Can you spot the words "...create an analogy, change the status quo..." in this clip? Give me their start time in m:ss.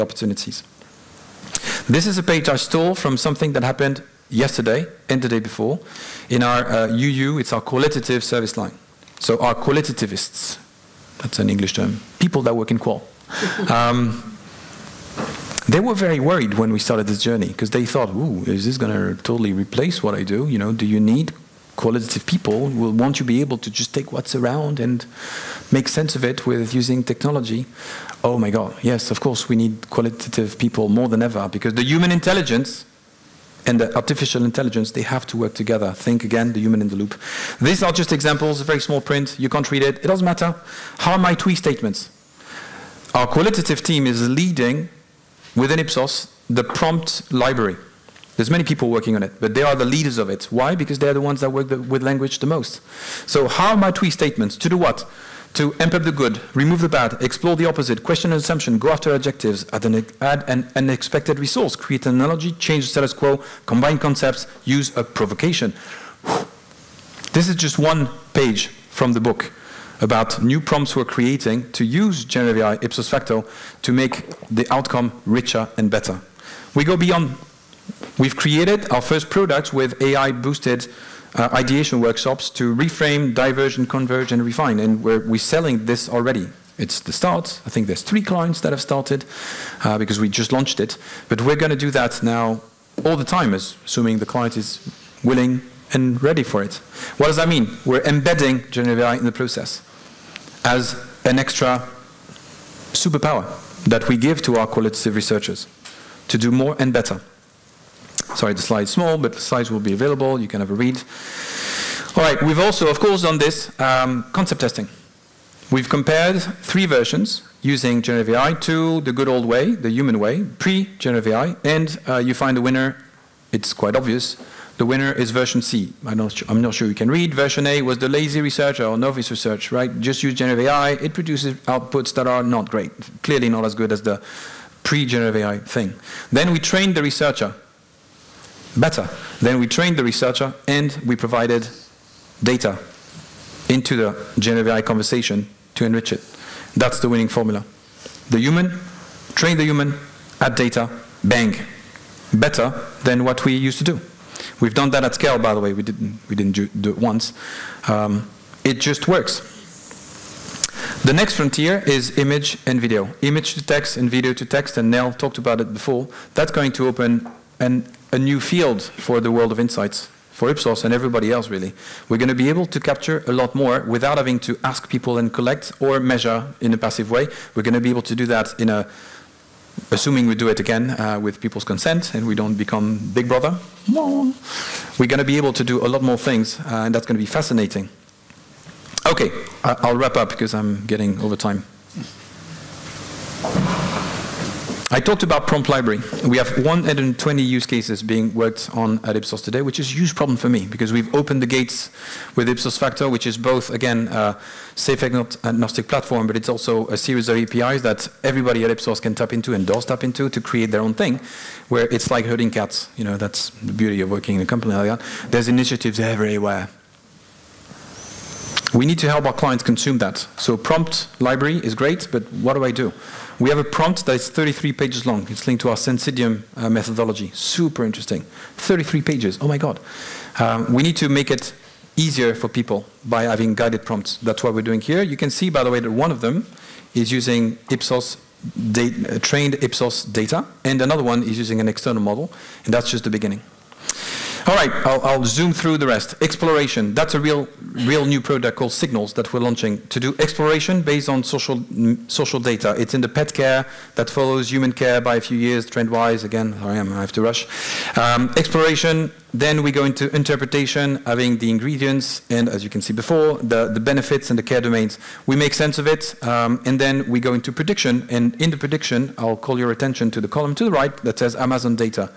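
1:01.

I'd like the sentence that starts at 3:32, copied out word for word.
You know, that's the beauty of working in a company like that.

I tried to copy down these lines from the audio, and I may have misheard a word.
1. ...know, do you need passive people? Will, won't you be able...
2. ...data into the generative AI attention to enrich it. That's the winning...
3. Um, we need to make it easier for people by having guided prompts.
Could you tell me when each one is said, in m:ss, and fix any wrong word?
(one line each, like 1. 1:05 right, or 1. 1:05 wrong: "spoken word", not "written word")
1. 0:20 wrong: "qualitative", not "passive"
2. 2:22 wrong: "conversation", not "attention"
3. 3:50 right.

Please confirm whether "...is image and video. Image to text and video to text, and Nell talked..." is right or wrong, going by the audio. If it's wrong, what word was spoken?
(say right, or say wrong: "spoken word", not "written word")
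right.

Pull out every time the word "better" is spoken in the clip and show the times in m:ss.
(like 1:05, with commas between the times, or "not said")
1:15, 1:46, 2:18, 2:32.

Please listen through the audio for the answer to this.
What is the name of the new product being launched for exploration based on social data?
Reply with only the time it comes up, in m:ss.
4:08.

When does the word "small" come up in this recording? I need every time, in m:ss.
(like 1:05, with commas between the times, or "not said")
0:38, 1:48.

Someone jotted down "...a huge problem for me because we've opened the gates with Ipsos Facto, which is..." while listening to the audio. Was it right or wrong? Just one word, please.
right.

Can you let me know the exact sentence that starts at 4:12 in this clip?
It's in the pet care that follows human care by a few years, trend-wise.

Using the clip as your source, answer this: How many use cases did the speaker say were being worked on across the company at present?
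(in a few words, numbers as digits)
120.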